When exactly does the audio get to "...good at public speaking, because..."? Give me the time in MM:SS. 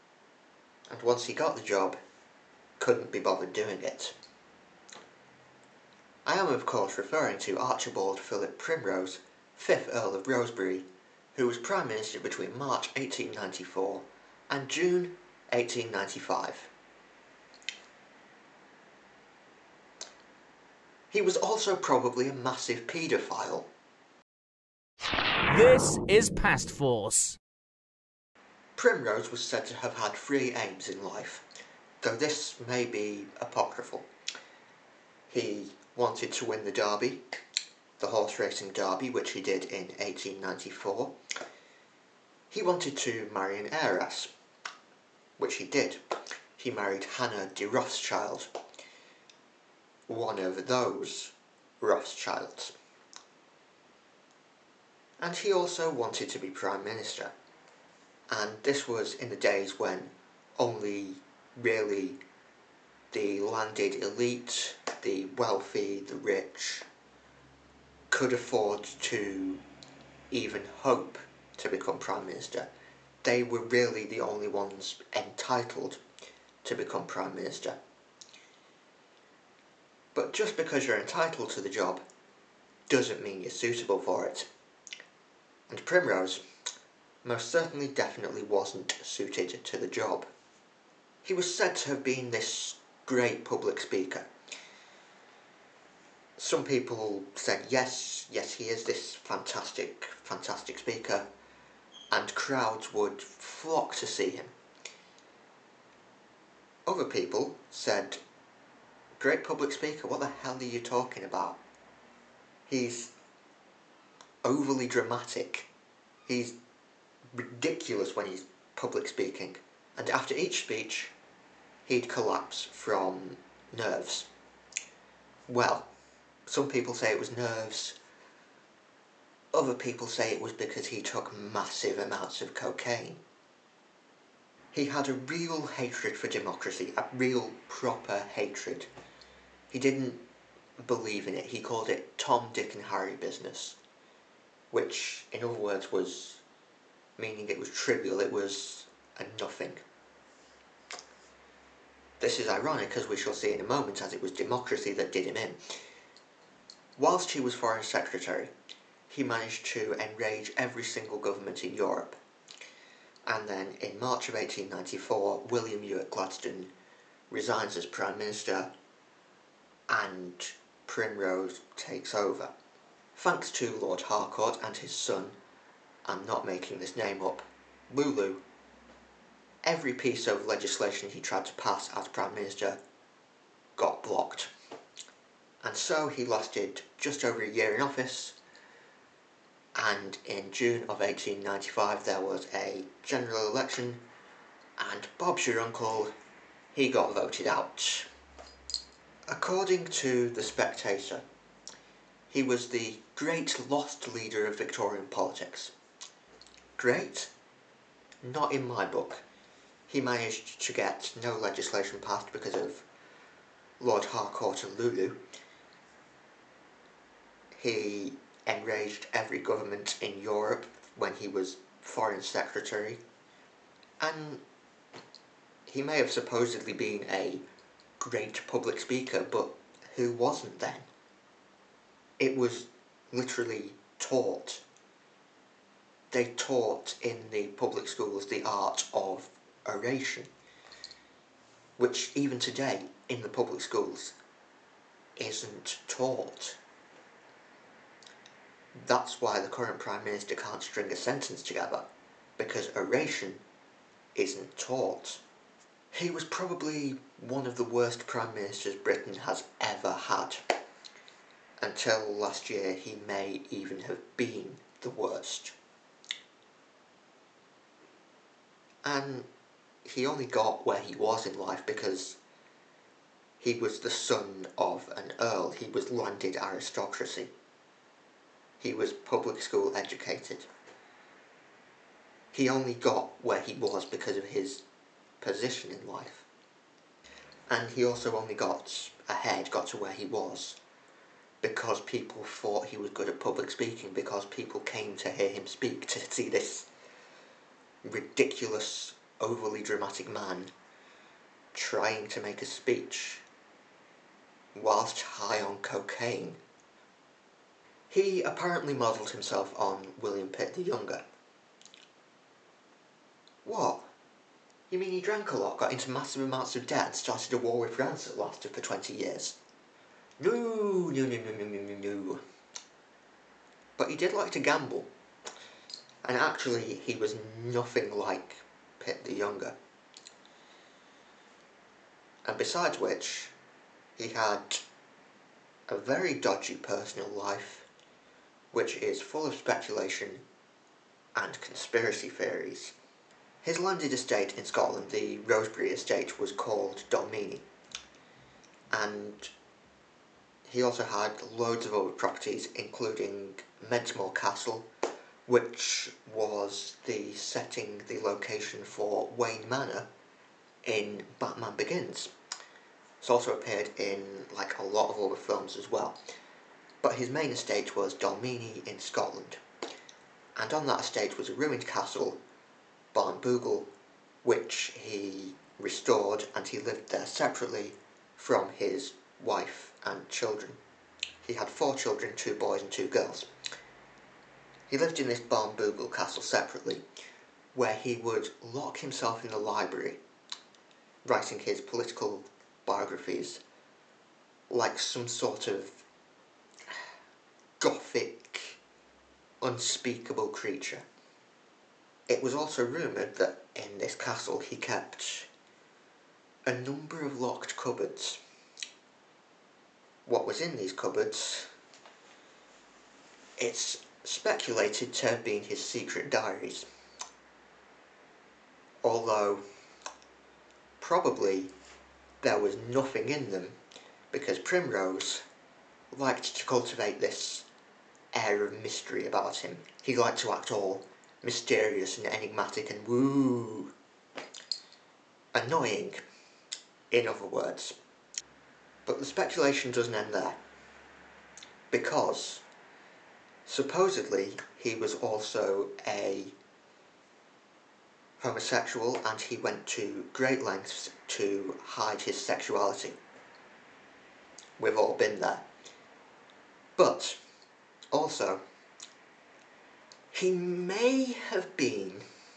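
04:52.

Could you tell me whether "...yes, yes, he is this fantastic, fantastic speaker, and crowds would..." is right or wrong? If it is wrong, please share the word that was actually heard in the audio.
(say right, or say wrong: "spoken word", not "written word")
right.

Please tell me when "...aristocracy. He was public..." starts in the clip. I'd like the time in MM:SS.
04:36.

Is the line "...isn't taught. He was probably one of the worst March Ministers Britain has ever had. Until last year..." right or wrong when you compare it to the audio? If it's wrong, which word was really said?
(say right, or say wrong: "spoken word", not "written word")
wrong: "Prime", not "March".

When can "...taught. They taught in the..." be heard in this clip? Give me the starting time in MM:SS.
03:53.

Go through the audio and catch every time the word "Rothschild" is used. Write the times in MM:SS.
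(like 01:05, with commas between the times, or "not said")
00:47, 00:51.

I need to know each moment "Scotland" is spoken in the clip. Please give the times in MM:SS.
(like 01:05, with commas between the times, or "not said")
05:44, 06:08.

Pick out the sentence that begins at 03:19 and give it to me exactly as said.
According to The Spectator, he was the great lost leader of Victorian politics.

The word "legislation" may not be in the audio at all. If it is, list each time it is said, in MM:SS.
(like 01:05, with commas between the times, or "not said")
03:00, 03:31.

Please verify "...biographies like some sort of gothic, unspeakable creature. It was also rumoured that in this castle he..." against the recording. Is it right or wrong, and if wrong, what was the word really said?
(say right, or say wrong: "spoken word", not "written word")
right.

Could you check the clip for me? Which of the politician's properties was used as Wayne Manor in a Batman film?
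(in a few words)
Mentmore Castle.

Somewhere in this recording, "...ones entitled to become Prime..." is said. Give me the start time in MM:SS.
01:14.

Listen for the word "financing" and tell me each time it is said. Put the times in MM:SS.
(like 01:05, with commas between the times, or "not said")
not said.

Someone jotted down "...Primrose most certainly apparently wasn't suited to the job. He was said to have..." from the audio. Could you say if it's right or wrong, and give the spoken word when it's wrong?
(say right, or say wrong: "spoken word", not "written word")
wrong: "definitely", not "apparently".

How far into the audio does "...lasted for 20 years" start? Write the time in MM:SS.
05:18.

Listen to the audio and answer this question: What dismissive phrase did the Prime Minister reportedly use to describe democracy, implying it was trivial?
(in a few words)
Tom, Dick and Harry business.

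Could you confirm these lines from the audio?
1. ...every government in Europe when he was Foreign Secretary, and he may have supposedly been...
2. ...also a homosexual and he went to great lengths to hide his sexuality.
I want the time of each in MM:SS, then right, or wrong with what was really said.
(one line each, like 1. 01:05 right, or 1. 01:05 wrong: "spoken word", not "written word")
1. 03:39 right
2. 07:24 right.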